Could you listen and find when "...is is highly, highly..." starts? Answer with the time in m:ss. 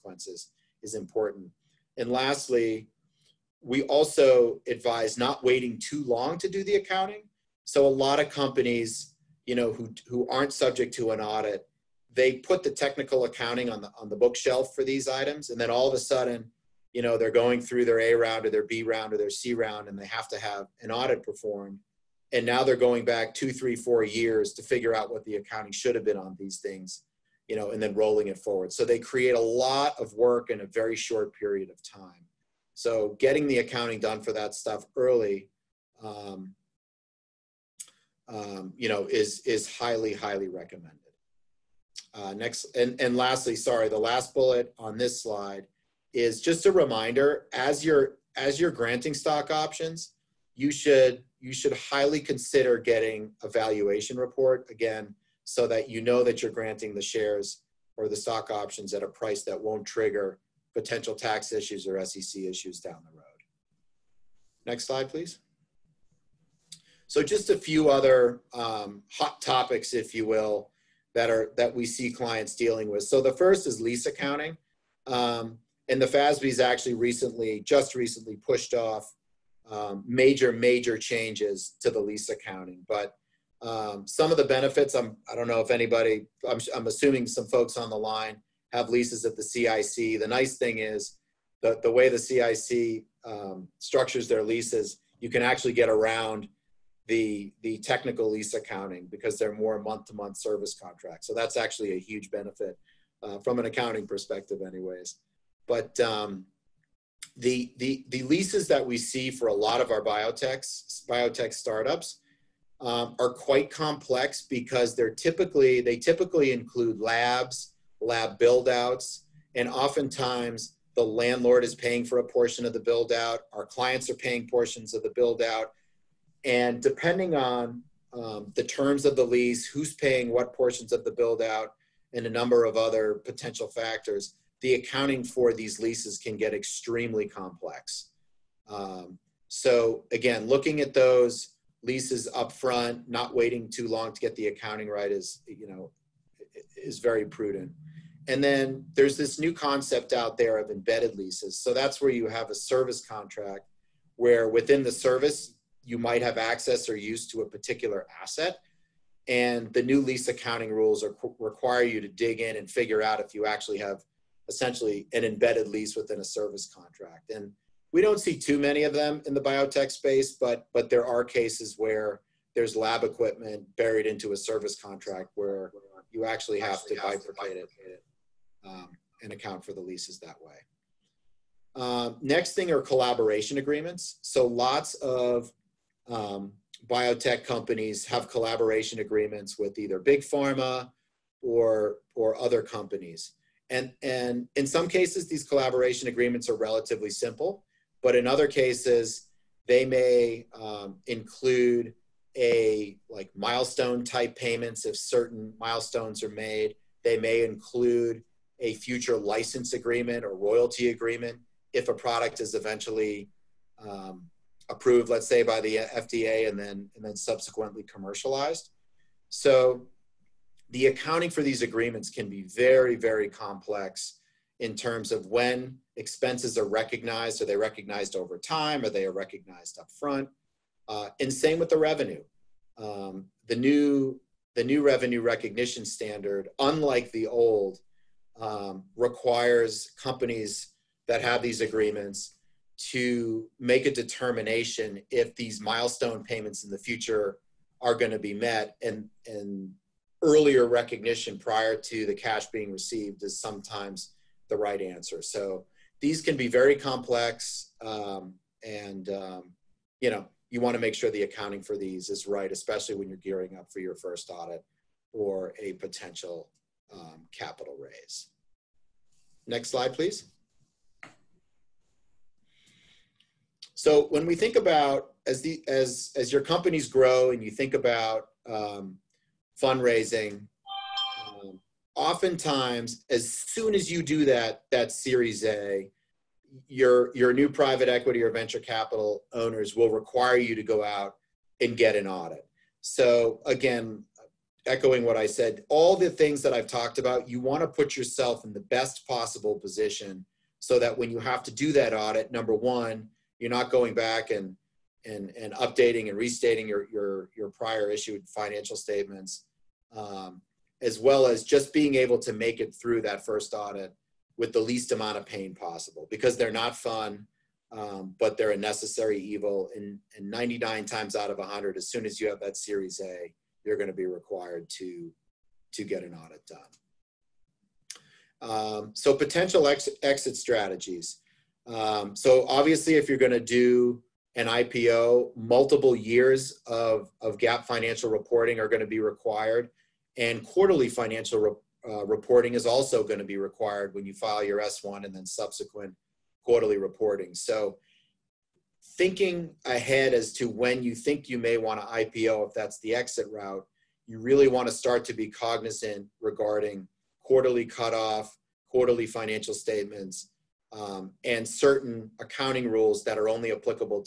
0:39.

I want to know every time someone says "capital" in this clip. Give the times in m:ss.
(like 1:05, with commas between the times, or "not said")
4:27, 4:48.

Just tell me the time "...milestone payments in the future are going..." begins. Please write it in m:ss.
4:05.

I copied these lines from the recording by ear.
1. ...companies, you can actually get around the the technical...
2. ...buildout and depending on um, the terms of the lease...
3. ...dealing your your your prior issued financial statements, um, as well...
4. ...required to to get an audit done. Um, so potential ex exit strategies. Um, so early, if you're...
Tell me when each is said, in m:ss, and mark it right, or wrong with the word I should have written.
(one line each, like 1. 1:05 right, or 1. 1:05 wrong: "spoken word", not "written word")
1. 1:34 wrong: "leases", not "companies"
2. 2:05 right
3. 5:06 wrong: "restating", not "dealing"
4. 5:24 wrong: "obviously", not "early".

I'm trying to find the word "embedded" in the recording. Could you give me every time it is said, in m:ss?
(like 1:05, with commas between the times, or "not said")
2:30, 2:45.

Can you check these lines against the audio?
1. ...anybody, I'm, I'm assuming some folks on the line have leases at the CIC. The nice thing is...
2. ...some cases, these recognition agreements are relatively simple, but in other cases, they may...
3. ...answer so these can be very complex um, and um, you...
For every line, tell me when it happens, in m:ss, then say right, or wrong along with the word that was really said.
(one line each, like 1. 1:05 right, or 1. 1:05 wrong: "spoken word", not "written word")
1. 1:25 right
2. 3:14 wrong: "collaboration", not "recognition"
3. 4:14 right.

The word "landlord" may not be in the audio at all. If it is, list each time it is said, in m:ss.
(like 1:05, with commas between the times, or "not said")
2:01.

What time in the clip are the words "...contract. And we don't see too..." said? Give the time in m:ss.
2:46.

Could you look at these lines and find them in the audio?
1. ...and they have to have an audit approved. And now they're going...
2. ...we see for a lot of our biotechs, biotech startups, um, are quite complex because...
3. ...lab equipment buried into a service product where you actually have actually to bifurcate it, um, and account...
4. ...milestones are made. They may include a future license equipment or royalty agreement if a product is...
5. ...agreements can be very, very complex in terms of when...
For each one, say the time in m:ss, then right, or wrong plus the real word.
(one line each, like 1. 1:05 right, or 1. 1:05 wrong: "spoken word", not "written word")
1. 0:19 wrong: "performed", not "approved"
2. 1:48 right
3. 2:52 wrong: "contract", not "product"
4. 3:25 wrong: "agreement", not "equipment"
5. 3:41 right.